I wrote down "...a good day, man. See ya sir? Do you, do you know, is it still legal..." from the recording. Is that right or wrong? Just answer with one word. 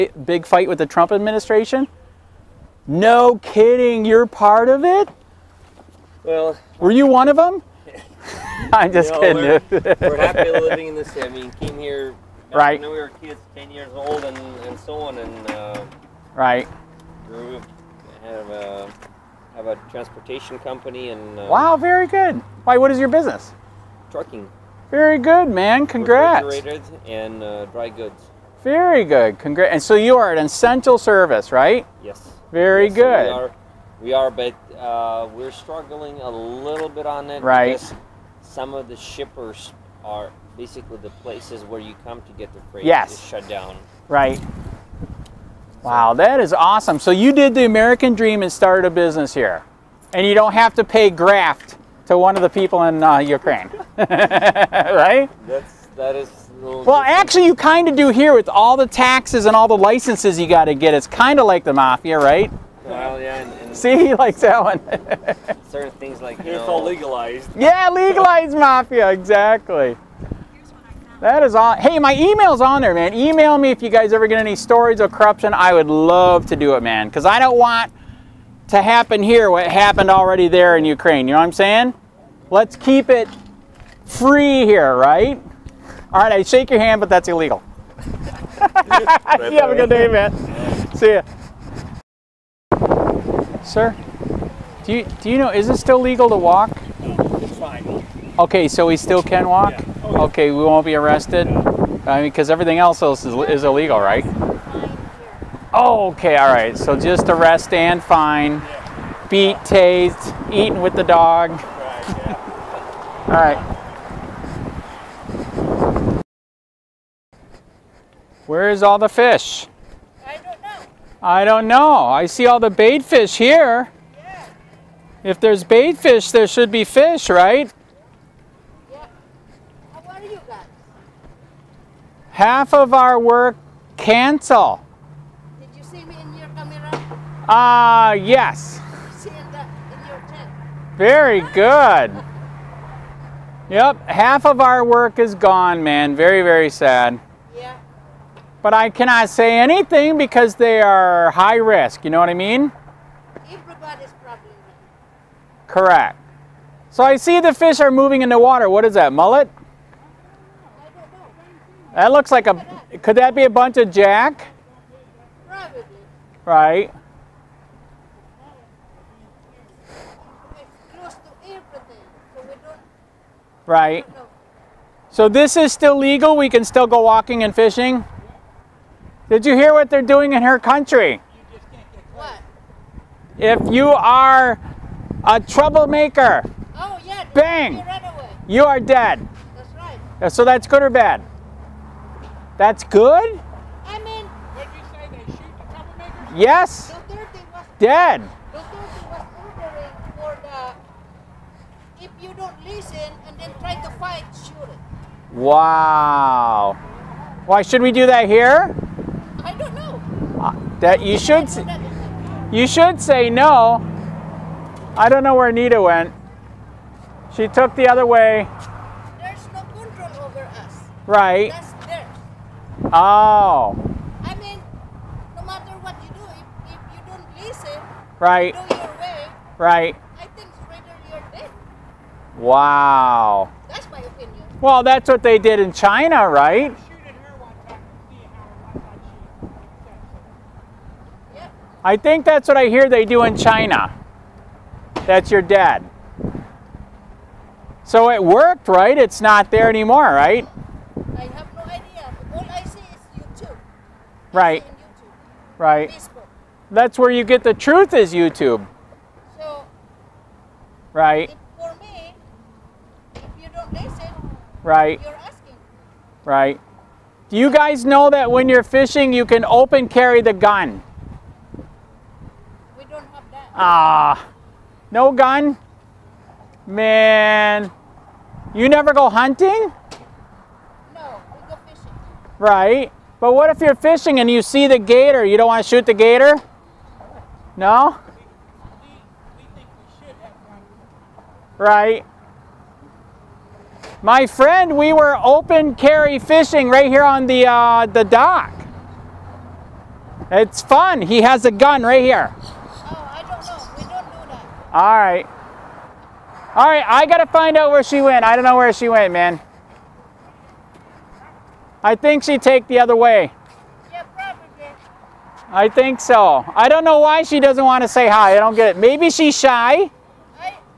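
right.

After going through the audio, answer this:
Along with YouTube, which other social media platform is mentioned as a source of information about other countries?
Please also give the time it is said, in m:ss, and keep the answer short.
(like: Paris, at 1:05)
Facebook, at 4:15.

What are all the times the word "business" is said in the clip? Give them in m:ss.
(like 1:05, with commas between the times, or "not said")
0:23, 0:48.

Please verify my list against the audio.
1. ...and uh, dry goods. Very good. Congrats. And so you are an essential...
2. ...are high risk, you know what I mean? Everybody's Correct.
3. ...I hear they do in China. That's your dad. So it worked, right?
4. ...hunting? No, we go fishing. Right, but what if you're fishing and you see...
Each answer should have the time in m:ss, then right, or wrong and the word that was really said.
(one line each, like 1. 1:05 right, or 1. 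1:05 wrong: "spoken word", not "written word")
1. 0:27 right
2. 2:30 right
3. 4:02 right
4. 4:39 right.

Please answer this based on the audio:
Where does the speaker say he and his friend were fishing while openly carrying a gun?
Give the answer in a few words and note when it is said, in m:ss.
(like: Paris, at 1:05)
the dock, at 4:57.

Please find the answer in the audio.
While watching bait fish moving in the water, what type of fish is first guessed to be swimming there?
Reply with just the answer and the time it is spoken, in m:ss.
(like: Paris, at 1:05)
mullet, at 2:39.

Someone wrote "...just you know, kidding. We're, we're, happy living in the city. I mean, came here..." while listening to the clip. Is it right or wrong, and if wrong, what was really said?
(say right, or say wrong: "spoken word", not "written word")
right.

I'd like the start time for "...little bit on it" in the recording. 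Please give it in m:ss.
0:36.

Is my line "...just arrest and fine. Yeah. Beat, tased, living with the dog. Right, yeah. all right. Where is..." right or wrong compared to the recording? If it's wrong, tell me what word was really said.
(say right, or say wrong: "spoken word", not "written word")
wrong: "eating", not "living".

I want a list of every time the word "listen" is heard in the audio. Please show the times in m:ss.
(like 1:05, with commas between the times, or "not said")
3:22, 3:47, 4:23.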